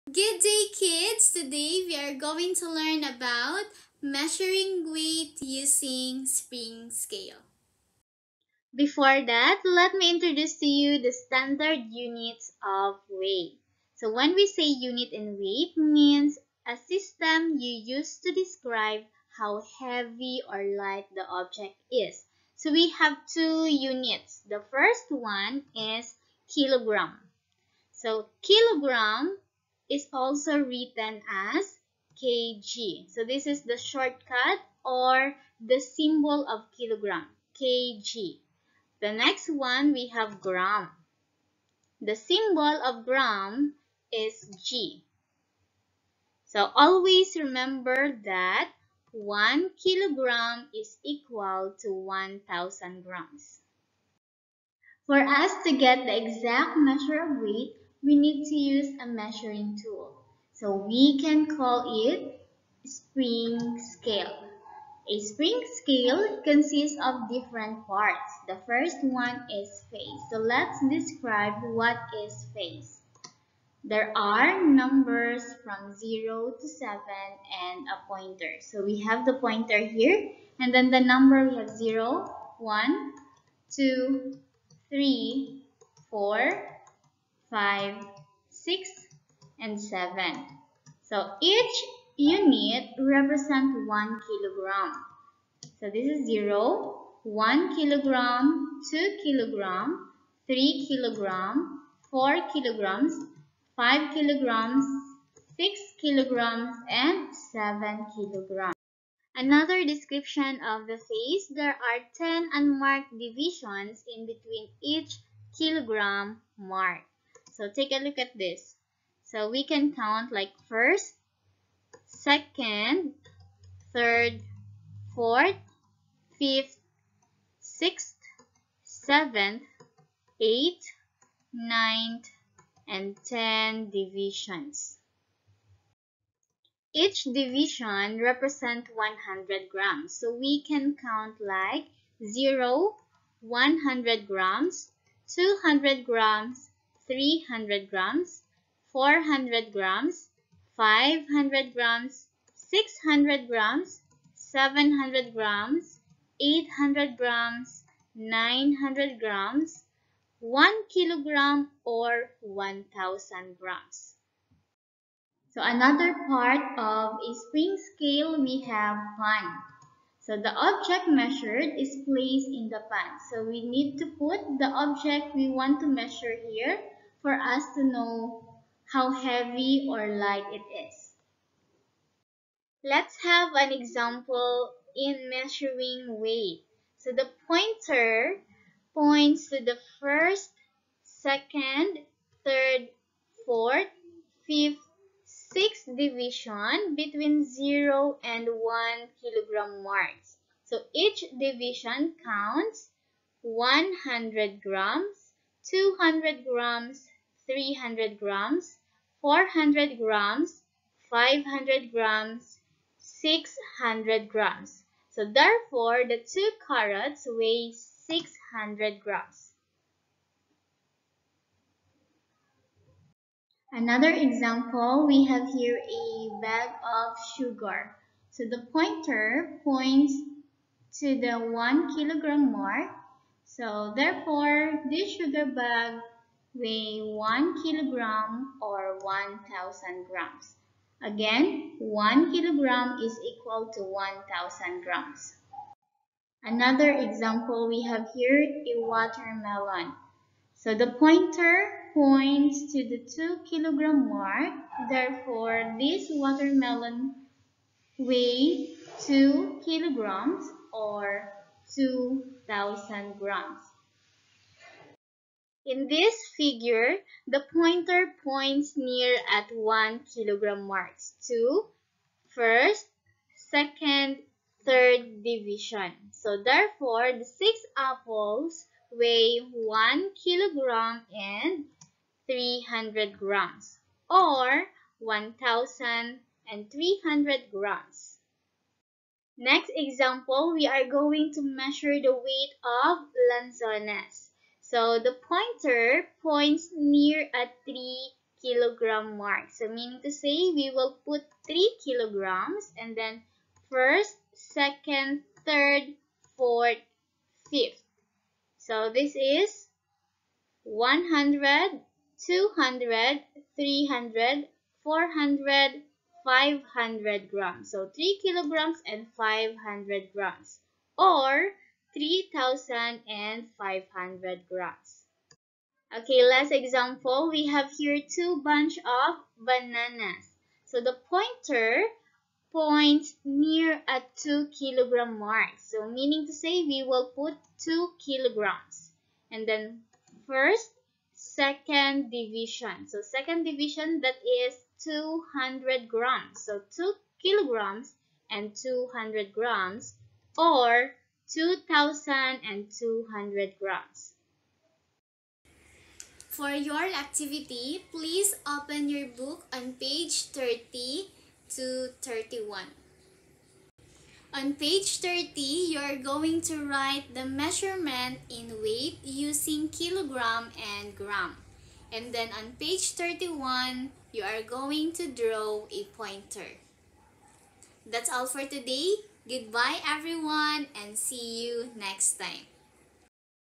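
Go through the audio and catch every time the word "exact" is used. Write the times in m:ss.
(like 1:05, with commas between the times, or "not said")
0:56.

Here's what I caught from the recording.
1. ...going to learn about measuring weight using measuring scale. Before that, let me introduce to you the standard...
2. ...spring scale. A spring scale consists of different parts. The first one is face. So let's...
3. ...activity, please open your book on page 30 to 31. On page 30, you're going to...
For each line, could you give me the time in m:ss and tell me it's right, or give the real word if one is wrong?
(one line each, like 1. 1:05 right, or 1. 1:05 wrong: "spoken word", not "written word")
1. 0:02 wrong: "spring", not "measuring"
2. 1:02 right
3. 5:56 right.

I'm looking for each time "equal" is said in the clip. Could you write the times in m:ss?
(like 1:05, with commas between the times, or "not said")
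0:51, 4:03.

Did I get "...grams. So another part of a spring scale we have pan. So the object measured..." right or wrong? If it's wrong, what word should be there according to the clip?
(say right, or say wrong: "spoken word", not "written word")
right.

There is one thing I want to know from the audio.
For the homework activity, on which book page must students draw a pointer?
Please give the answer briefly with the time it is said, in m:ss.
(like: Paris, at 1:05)
31, at 6:12.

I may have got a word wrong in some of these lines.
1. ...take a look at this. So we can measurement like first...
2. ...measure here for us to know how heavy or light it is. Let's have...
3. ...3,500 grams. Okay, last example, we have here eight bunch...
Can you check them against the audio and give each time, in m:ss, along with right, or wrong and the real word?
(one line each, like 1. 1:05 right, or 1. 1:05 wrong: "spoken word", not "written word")
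1. 1:57 wrong: "count", not "measurement"
2. 2:55 right
3. 5:21 wrong: "two", not "eight".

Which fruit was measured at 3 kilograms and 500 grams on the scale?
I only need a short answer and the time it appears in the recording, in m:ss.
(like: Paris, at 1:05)
Lanzones, at 4:53.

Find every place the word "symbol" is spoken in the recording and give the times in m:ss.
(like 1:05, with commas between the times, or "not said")
0:35, 0:42.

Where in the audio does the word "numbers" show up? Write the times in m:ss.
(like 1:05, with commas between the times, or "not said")
1:14, 1:20.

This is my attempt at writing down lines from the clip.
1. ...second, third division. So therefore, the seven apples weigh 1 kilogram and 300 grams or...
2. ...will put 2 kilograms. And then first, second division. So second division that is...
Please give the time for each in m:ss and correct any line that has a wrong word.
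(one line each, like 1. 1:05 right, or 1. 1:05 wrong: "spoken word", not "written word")
1. 4:33 wrong: "six", not "seven"
2. 5:36 right.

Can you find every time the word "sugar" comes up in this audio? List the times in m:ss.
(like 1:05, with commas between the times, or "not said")
3:47, 3:55.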